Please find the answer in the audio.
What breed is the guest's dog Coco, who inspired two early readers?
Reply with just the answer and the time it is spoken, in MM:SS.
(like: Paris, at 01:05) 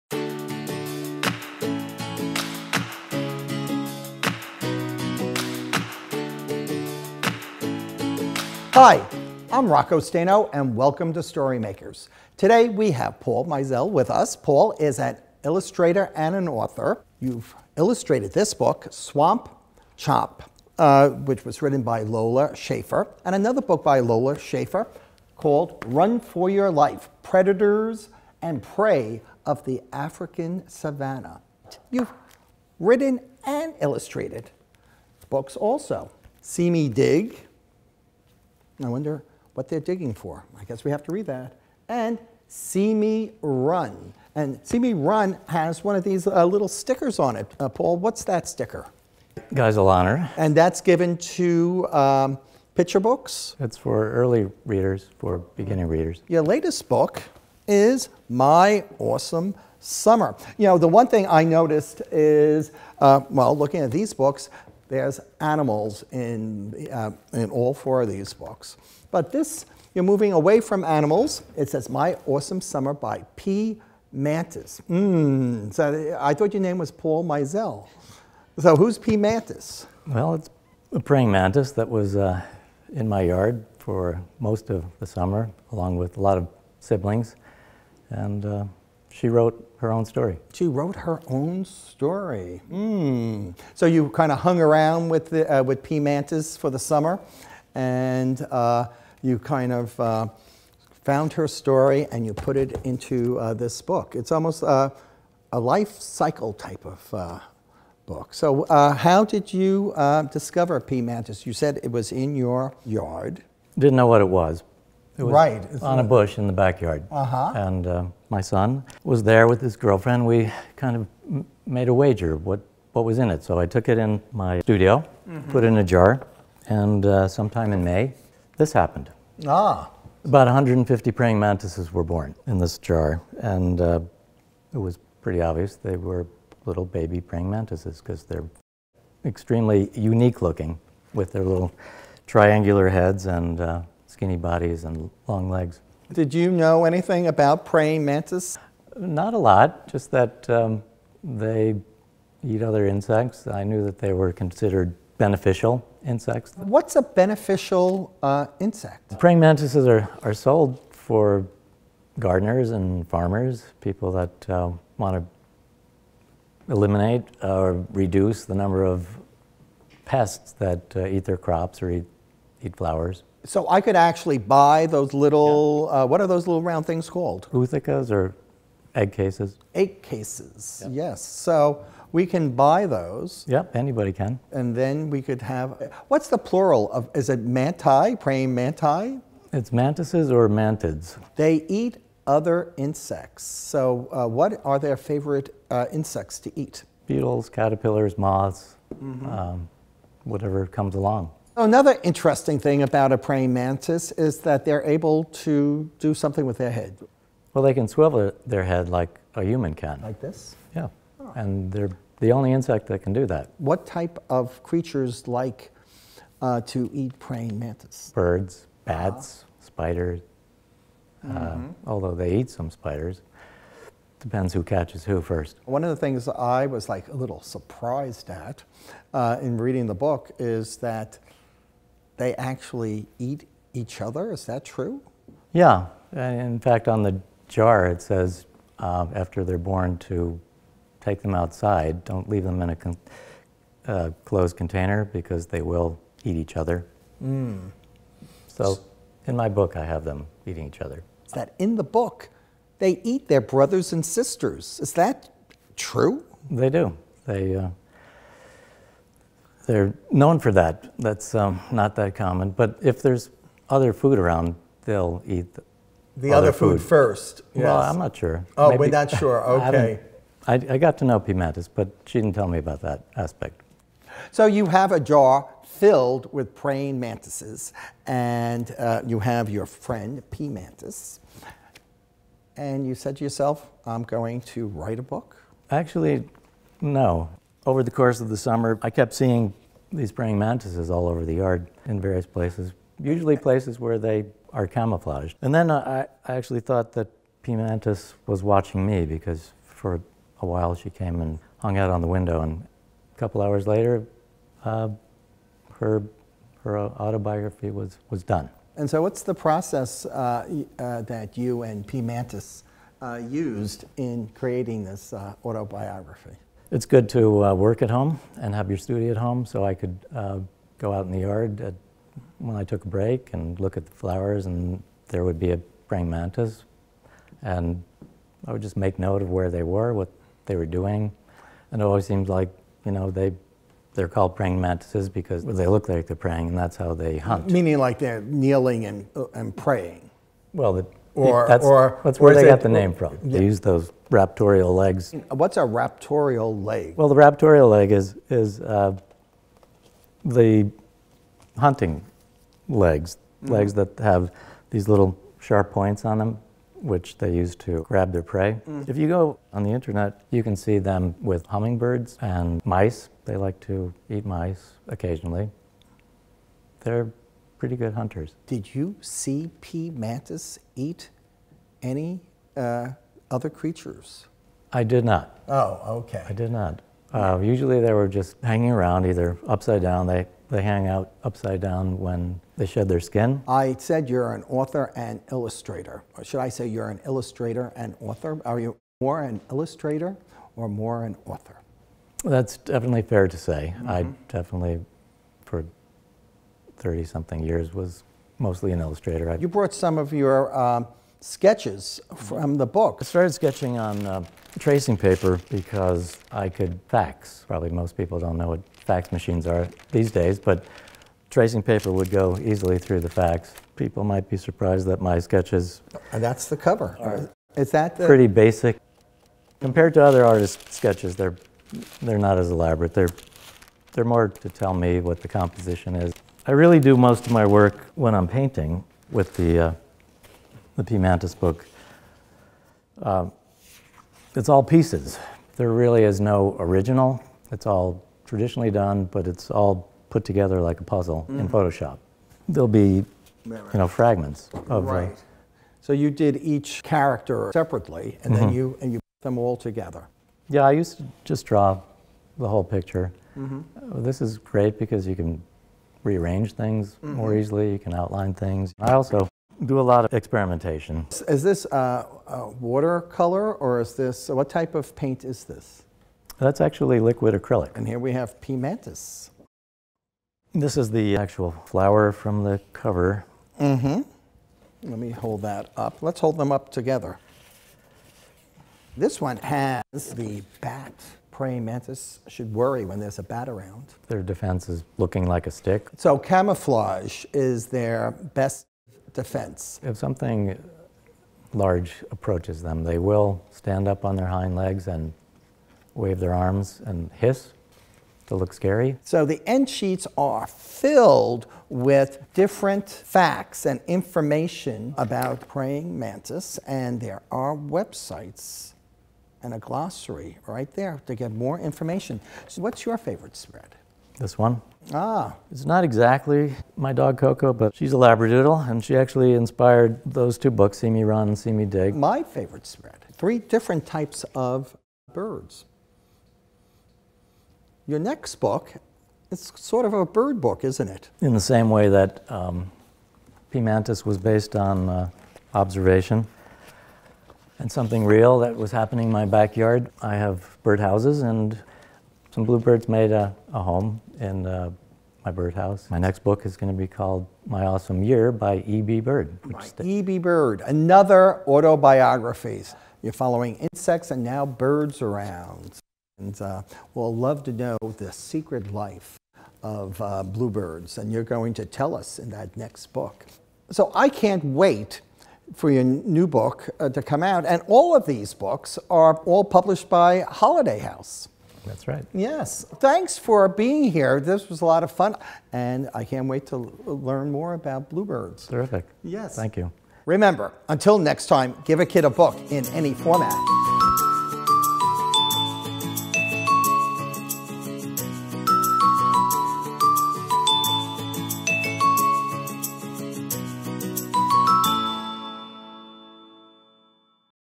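Labradoodle, at 08:37.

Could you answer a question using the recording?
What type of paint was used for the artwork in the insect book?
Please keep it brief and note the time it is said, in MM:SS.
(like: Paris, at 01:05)
Liquid acrylic, at 07:47.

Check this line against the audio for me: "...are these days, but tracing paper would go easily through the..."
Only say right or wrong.
right.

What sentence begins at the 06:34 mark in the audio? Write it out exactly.
definitely, for 30 something years, was mostly an illustrator.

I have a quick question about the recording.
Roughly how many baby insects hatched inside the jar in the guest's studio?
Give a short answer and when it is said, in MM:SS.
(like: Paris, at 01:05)
150, at 02:10.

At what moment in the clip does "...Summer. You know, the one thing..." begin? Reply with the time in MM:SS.
00:59.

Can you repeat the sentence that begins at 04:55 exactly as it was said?
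And then I, I actually thought that P.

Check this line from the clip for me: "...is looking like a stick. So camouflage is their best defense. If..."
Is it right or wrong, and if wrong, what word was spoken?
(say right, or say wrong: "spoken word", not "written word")
right.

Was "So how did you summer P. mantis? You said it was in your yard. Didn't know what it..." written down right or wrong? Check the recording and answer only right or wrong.
wrong.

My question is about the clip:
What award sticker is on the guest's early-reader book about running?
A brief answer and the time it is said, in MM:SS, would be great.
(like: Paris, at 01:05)
Geisel Honor, at 00:49.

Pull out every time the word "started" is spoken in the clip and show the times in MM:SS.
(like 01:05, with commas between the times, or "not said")
06:43.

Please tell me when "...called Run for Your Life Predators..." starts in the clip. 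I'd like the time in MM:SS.
00:25.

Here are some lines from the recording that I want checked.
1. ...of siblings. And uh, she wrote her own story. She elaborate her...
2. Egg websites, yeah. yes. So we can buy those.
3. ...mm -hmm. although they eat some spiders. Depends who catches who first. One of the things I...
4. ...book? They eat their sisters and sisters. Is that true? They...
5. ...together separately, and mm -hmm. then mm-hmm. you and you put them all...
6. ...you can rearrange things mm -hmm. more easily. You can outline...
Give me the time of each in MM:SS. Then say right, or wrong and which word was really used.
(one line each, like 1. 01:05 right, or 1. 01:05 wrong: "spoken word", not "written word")
1. 01:26 wrong: "wrote", not "elaborate"
2. 02:59 wrong: "cases", not "websites"
3. 03:41 right
4. 04:11 wrong: "brothers", not "sisters"
5. 07:26 wrong: "character", not "together"
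6. 07:35 right.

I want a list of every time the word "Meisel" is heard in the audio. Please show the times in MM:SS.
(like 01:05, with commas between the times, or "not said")
00:13, 01:17.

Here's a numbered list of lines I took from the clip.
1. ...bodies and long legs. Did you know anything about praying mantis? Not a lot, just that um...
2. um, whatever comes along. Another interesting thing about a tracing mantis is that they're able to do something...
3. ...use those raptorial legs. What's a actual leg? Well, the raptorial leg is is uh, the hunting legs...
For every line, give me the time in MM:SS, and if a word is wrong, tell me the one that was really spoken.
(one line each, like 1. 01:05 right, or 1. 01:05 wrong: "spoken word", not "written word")
1. 02:24 right
2. 03:19 wrong: "praying", not "tracing"
3. 05:43 wrong: "raptorial", not "actual".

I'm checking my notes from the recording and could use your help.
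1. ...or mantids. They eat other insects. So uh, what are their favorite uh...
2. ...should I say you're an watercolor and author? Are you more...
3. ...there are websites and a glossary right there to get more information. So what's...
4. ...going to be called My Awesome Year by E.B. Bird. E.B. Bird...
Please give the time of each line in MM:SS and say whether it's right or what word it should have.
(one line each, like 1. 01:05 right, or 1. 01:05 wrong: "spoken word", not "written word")
1. 03:10 right
2. 06:26 wrong: "illustrator", not "watercolor"
3. 08:27 right
4. 09:06 right.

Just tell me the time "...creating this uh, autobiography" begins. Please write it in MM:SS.
05:14.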